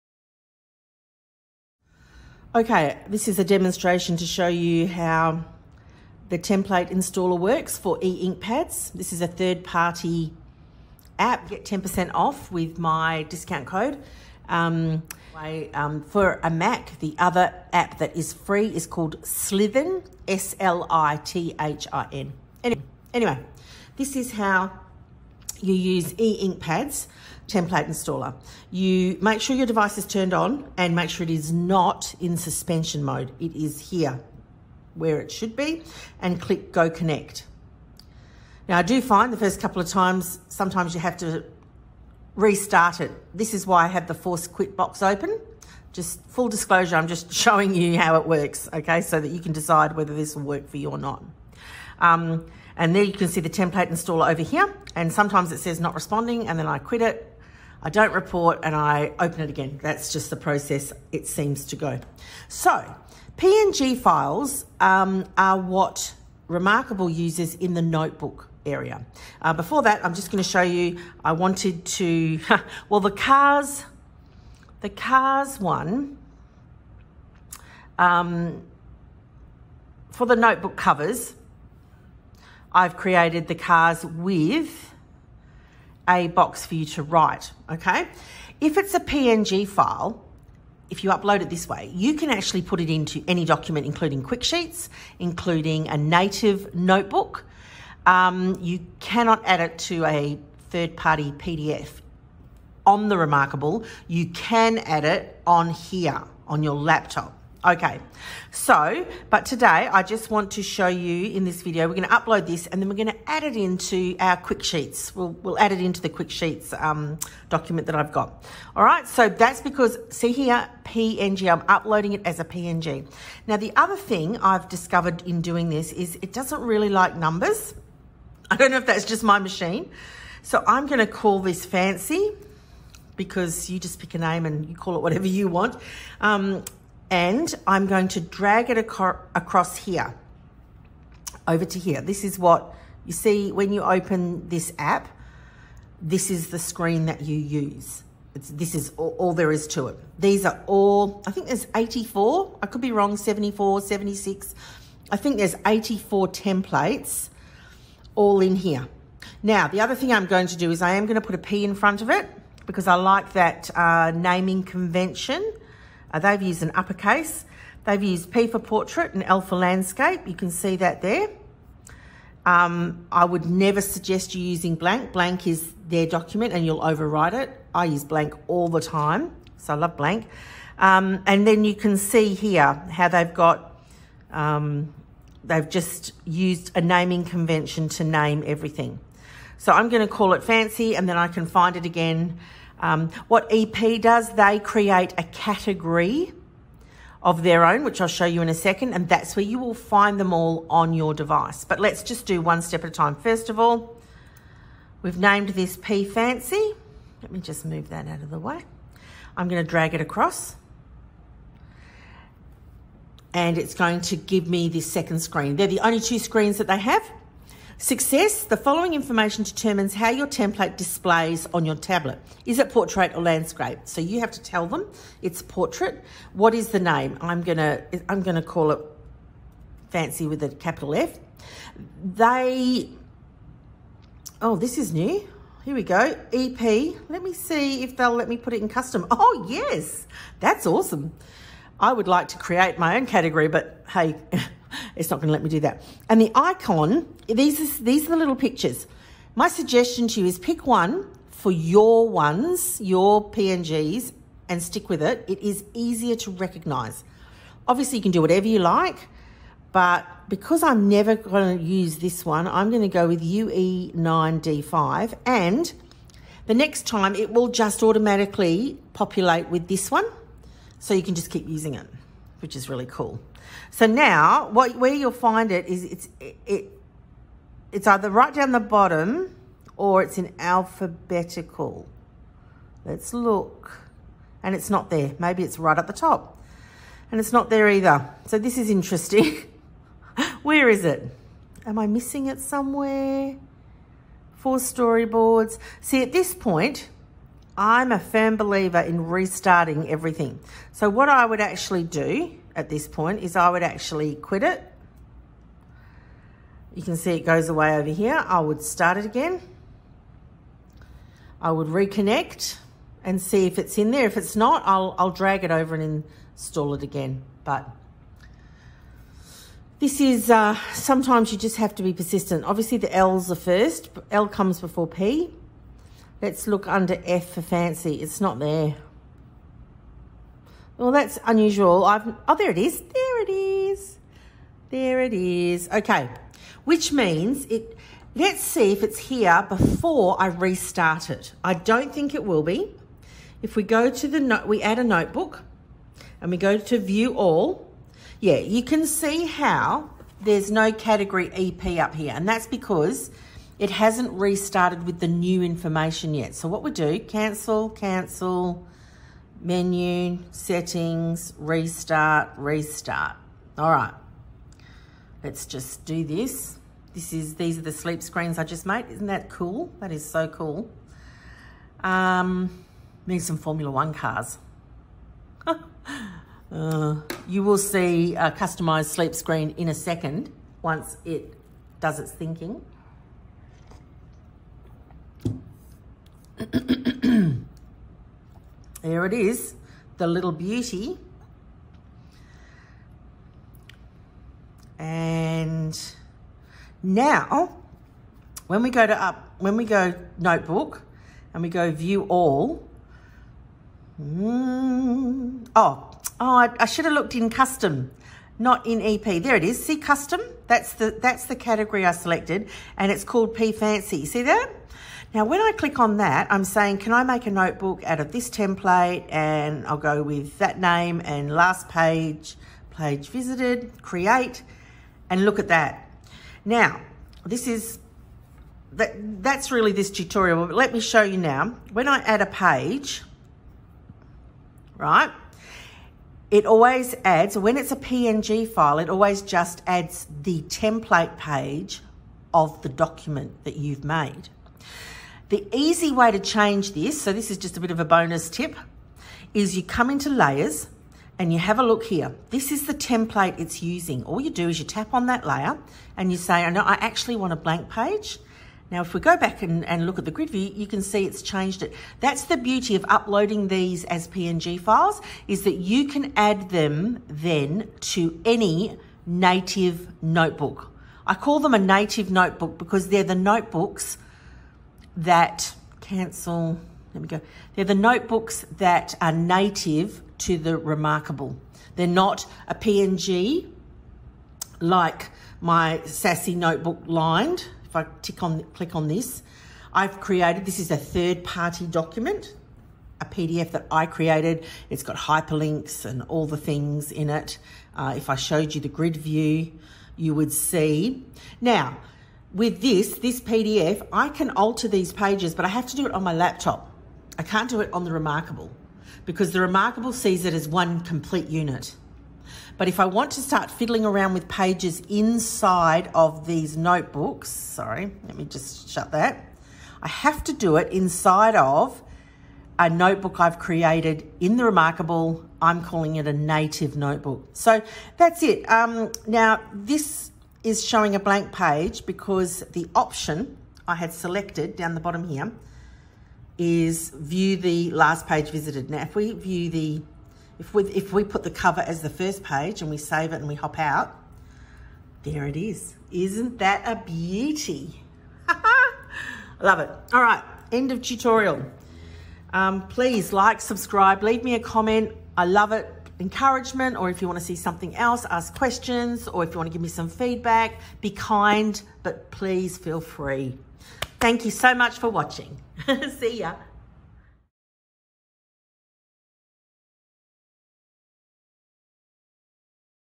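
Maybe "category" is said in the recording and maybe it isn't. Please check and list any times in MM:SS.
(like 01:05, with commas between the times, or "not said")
03:15, 04:03, 05:50, 06:51.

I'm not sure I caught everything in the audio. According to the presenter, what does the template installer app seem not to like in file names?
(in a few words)
numbers.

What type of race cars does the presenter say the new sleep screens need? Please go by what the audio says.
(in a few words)
Formula One.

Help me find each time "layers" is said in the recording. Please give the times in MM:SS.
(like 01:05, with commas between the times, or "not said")
07:30, 07:35.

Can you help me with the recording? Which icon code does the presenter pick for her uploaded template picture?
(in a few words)
UE9D5.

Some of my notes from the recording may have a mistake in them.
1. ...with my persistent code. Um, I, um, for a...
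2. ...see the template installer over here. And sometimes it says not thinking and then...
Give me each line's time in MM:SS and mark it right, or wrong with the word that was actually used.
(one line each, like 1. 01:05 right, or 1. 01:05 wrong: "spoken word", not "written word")
1. 00:12 wrong: "discount", not "persistent"
2. 00:53 wrong: "responding", not "thinking".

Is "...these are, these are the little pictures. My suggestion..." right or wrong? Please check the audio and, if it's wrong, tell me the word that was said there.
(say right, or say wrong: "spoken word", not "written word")
right.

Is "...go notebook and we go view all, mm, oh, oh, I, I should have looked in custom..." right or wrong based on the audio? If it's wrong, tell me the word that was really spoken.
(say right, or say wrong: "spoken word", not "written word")
right.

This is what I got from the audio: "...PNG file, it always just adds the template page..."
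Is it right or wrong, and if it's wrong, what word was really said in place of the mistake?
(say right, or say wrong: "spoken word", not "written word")
right.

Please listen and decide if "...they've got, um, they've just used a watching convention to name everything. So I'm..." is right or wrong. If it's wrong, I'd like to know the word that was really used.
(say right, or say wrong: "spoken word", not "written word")
wrong: "naming", not "watching".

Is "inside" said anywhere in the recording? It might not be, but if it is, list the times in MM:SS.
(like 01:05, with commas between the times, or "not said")
08:34, 08:40.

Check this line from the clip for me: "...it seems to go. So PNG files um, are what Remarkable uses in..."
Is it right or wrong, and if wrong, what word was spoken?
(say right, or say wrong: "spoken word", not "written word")
right.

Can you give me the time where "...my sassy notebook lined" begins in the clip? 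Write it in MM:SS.
08:05.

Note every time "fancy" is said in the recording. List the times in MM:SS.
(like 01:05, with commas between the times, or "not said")
02:11, 03:10, 03:26, 03:49, 05:27, 06:53.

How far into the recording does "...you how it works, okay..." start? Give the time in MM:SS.
00:47.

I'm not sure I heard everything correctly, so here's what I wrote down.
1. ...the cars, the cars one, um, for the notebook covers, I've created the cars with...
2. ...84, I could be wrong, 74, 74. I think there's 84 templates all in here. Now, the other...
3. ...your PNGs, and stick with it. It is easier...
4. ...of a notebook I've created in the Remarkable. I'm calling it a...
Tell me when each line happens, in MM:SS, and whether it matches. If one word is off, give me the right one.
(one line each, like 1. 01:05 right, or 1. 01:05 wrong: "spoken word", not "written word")
1. 01:12 right
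2. 02:31 wrong: "76", not "74"
3. 04:12 right
4. 08:41 right.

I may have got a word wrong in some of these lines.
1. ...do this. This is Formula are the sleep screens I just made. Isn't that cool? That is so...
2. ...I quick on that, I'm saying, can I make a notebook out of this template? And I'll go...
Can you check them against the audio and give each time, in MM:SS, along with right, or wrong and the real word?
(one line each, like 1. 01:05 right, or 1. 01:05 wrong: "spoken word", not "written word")
1. 06:05 wrong: "These", not "Formula"
2. 06:55 wrong: "click", not "quick".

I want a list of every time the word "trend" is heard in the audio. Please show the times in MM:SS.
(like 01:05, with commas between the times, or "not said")
not said.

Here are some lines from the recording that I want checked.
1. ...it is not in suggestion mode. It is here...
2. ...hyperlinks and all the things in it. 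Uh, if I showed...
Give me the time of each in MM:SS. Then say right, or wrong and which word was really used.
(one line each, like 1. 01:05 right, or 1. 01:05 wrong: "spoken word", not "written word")
1. 00:31 wrong: "suspension", not "suggestion"
2. 08:14 right.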